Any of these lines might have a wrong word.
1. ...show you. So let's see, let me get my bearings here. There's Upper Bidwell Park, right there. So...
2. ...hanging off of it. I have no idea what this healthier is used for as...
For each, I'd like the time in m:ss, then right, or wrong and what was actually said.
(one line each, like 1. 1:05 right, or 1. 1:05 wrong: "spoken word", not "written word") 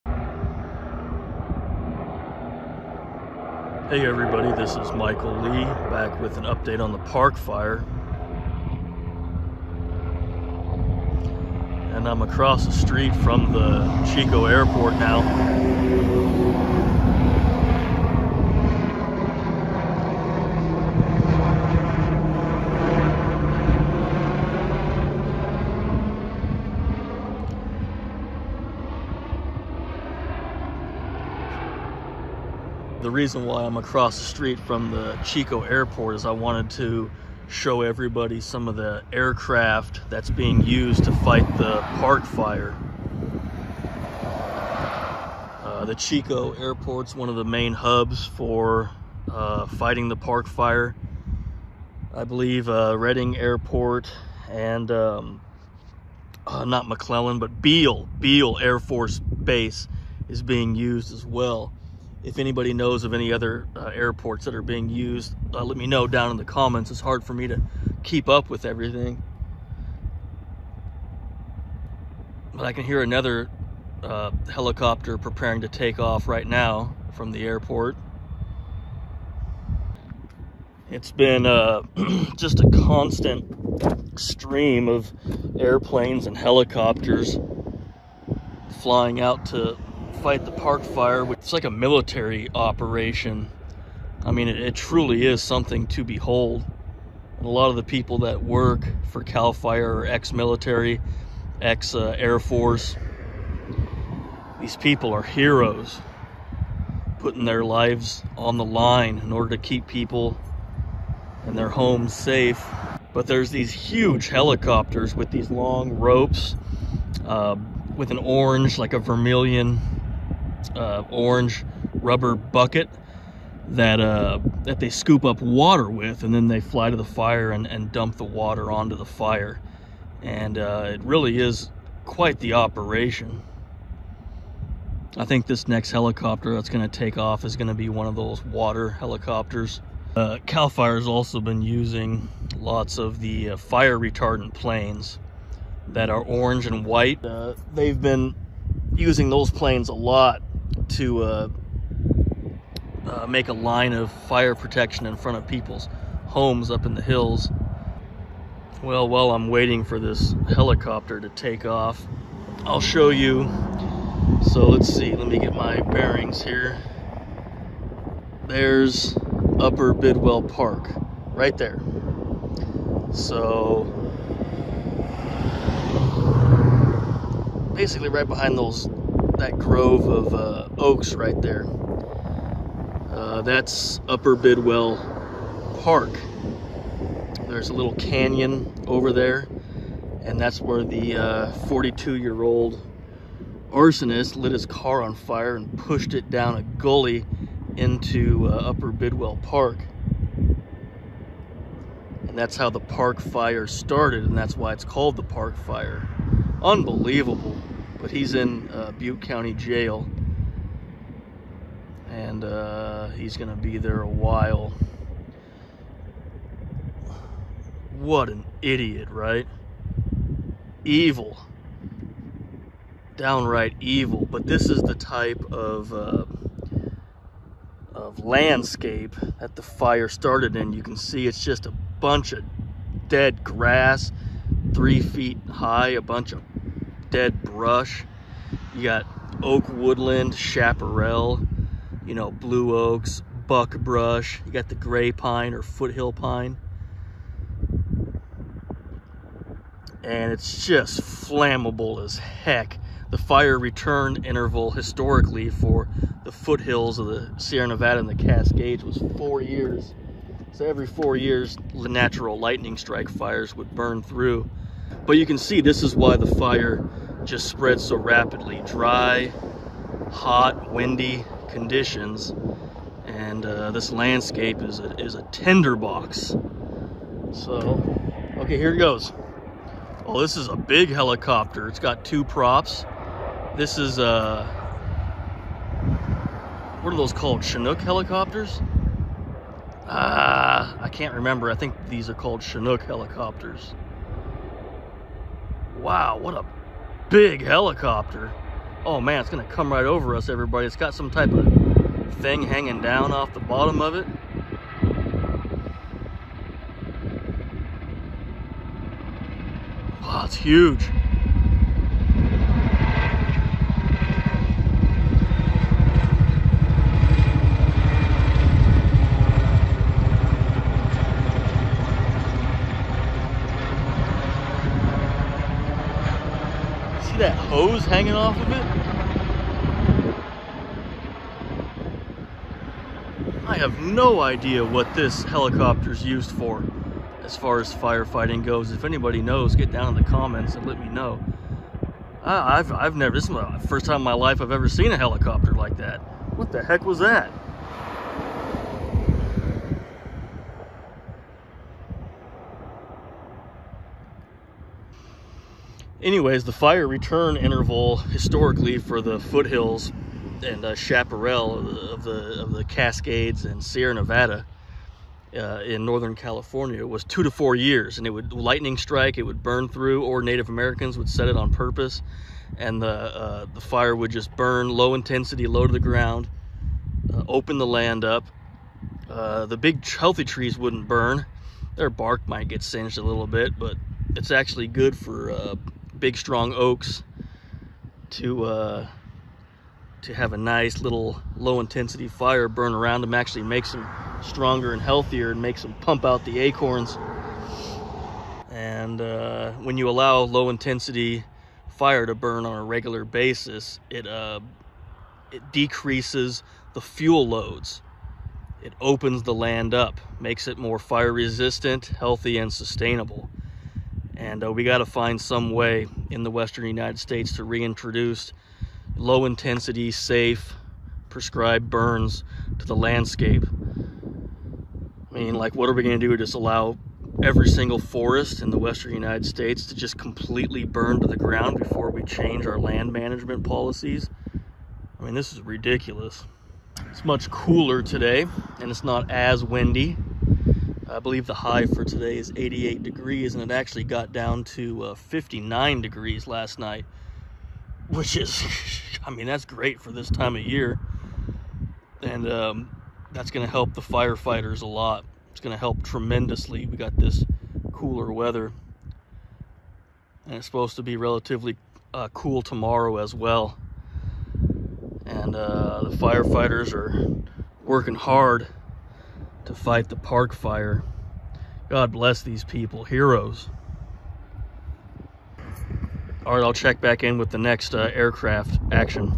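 1. 2:42 right
2. 5:27 wrong: "helicopter", not "healthier".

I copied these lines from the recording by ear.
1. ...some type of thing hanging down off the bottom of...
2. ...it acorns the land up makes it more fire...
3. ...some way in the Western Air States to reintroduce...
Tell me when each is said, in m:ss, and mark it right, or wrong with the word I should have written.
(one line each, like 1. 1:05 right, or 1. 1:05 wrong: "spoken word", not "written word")
1. 5:00 right
2. 6:48 wrong: "opens", not "acorns"
3. 6:55 wrong: "United", not "Air".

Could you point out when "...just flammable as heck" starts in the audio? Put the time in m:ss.
4:10.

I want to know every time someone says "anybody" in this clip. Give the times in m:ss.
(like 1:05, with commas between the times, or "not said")
1:02, 5:38.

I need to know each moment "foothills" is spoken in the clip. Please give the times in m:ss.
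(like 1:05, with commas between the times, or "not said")
4:05, 4:16, 5:59.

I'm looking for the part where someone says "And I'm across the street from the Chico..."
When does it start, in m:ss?
0:11.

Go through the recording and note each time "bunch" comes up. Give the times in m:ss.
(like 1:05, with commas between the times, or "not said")
3:51, 3:56.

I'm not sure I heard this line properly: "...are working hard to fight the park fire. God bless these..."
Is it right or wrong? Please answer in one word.
right.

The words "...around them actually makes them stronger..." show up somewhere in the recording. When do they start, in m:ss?
6:32.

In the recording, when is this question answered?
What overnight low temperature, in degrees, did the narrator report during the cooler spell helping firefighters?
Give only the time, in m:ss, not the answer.
7:24.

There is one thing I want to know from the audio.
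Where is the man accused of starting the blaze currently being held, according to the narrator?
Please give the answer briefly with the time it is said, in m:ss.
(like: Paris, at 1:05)
Butte County Jail, at 3:28.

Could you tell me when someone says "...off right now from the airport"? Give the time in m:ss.
1:15.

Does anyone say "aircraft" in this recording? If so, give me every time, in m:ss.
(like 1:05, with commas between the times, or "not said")
0:39, 7:57.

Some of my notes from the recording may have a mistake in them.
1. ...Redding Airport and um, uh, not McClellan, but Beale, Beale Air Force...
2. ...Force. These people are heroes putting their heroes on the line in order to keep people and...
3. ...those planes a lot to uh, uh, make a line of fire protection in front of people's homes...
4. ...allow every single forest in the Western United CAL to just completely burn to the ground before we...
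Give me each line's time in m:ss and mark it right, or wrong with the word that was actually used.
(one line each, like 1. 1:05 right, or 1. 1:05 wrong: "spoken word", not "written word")
1. 0:52 right
2. 1:42 wrong: "lives", not "heroes"
3. 2:29 right
4. 7:06 wrong: "States", not "CAL".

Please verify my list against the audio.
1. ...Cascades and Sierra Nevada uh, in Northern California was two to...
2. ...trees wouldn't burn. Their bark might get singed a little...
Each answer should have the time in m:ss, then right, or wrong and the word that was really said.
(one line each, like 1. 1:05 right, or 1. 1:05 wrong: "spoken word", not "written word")
1. 6:02 right
2. 6:20 right.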